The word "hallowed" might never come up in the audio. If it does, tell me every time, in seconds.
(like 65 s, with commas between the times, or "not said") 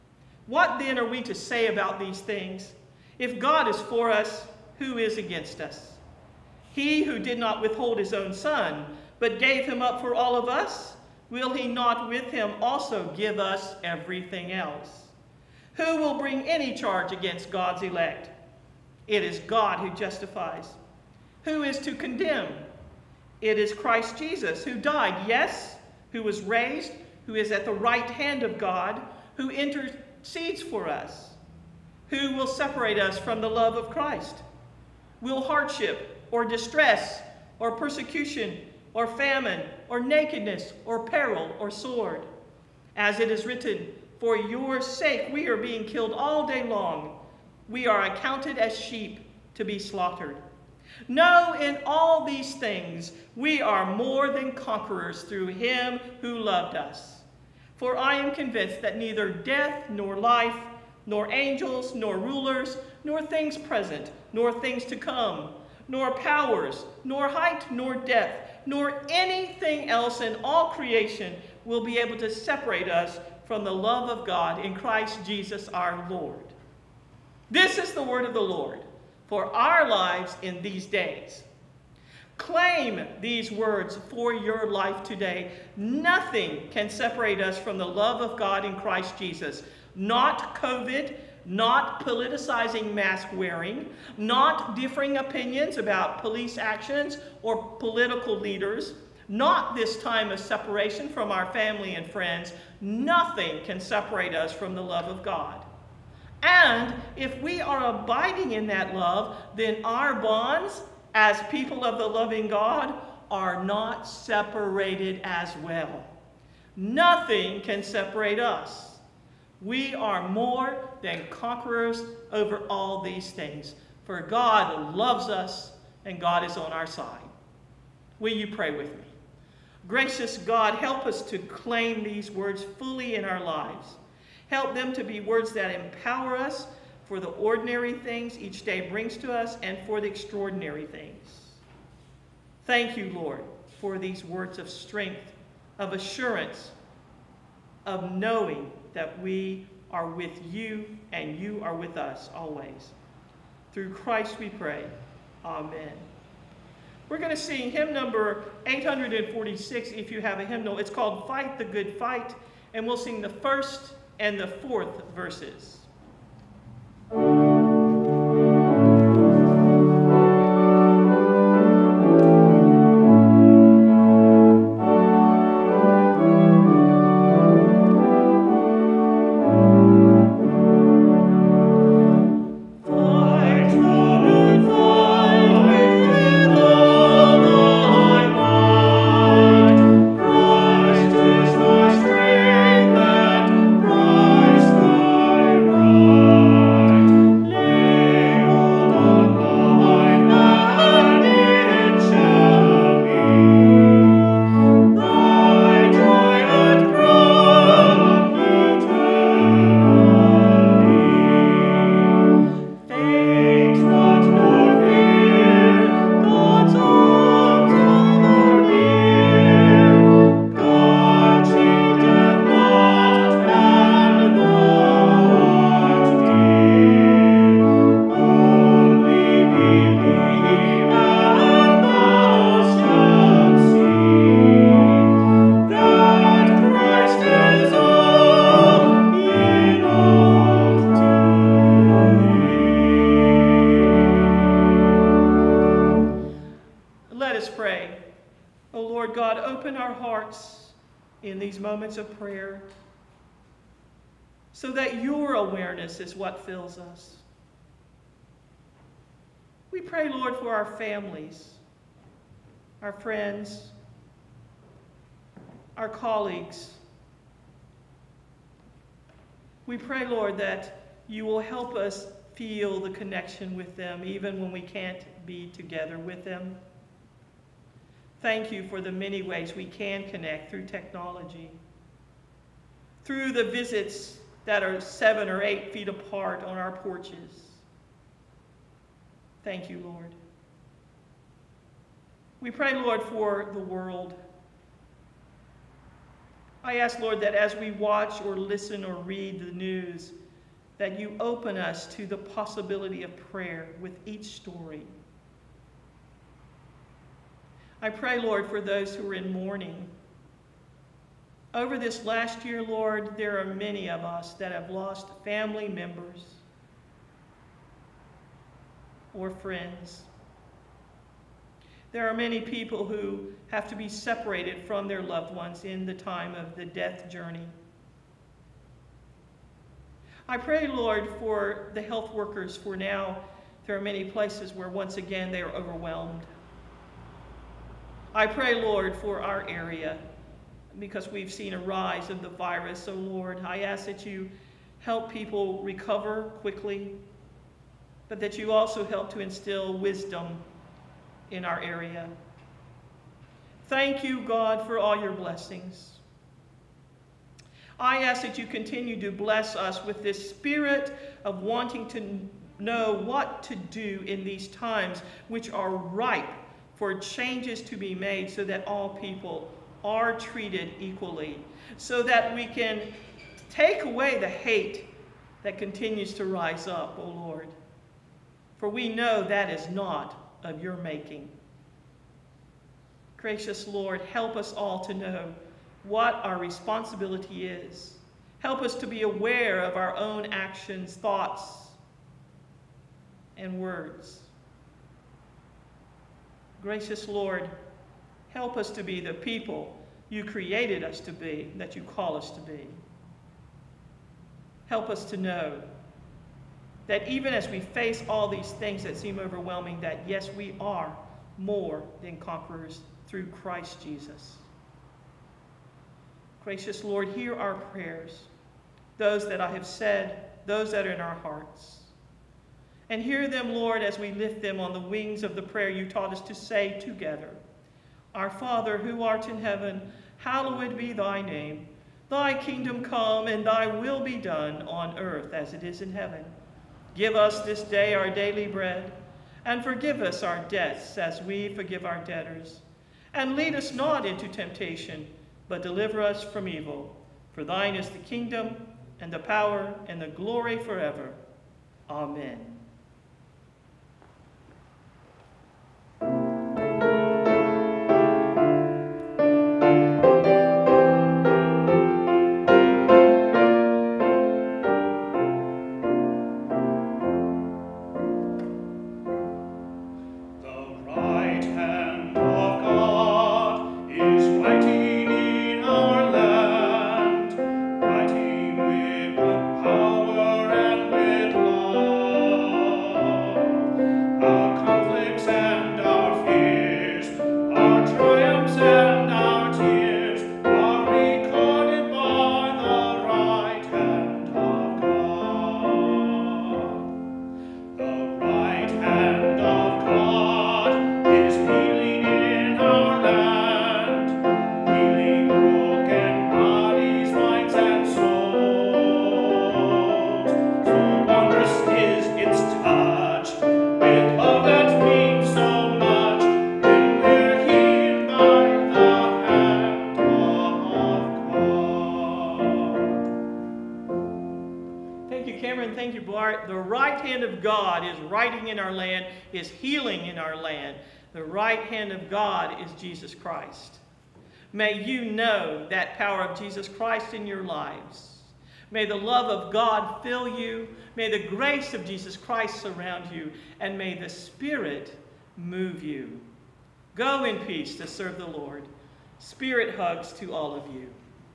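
430 s.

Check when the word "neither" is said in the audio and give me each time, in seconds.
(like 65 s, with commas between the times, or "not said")
58 s.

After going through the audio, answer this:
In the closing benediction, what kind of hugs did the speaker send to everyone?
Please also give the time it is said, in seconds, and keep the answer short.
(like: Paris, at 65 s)
Spirit hugs, at 549 s.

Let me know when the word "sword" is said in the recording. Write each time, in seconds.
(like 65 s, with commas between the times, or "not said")
41 s.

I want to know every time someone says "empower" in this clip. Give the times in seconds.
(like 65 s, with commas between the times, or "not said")
135 s.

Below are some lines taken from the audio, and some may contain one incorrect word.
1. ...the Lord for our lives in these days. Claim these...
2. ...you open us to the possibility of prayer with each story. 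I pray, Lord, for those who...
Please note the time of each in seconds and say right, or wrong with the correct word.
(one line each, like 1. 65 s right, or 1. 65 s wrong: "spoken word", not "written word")
1. 78 s right
2. 300 s right.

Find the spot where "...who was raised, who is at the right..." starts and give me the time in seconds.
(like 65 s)
26 s.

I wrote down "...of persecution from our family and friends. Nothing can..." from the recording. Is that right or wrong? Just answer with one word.
wrong.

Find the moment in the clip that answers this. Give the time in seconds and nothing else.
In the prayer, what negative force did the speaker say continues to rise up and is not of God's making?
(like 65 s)
374 s.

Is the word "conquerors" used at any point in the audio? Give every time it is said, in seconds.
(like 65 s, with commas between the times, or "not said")
54 s, 121 s, 412 s.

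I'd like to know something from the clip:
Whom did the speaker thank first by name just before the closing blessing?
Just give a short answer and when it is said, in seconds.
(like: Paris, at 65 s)
Cameron, at 525 s.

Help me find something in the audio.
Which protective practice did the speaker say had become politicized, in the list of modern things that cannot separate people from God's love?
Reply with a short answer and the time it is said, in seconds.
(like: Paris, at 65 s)
Mask wearing, at 92 s.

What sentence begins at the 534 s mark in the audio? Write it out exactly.
May you know that power of Jesus Christ in your lives.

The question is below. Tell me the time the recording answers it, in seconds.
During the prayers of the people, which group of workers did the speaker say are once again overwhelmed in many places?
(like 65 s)
331 s.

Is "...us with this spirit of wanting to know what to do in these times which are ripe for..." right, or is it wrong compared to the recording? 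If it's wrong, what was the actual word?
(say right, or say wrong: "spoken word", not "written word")
right.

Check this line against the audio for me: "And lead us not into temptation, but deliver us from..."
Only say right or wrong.
right.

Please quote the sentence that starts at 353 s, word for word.
Thank you, God, for all your blessings.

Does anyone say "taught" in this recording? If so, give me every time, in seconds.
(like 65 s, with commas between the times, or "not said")
425 s.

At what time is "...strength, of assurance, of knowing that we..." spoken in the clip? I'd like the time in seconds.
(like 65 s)
144 s.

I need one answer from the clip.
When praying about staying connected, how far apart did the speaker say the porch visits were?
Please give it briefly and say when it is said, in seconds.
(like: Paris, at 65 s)
Seven or eight feet, at 284 s.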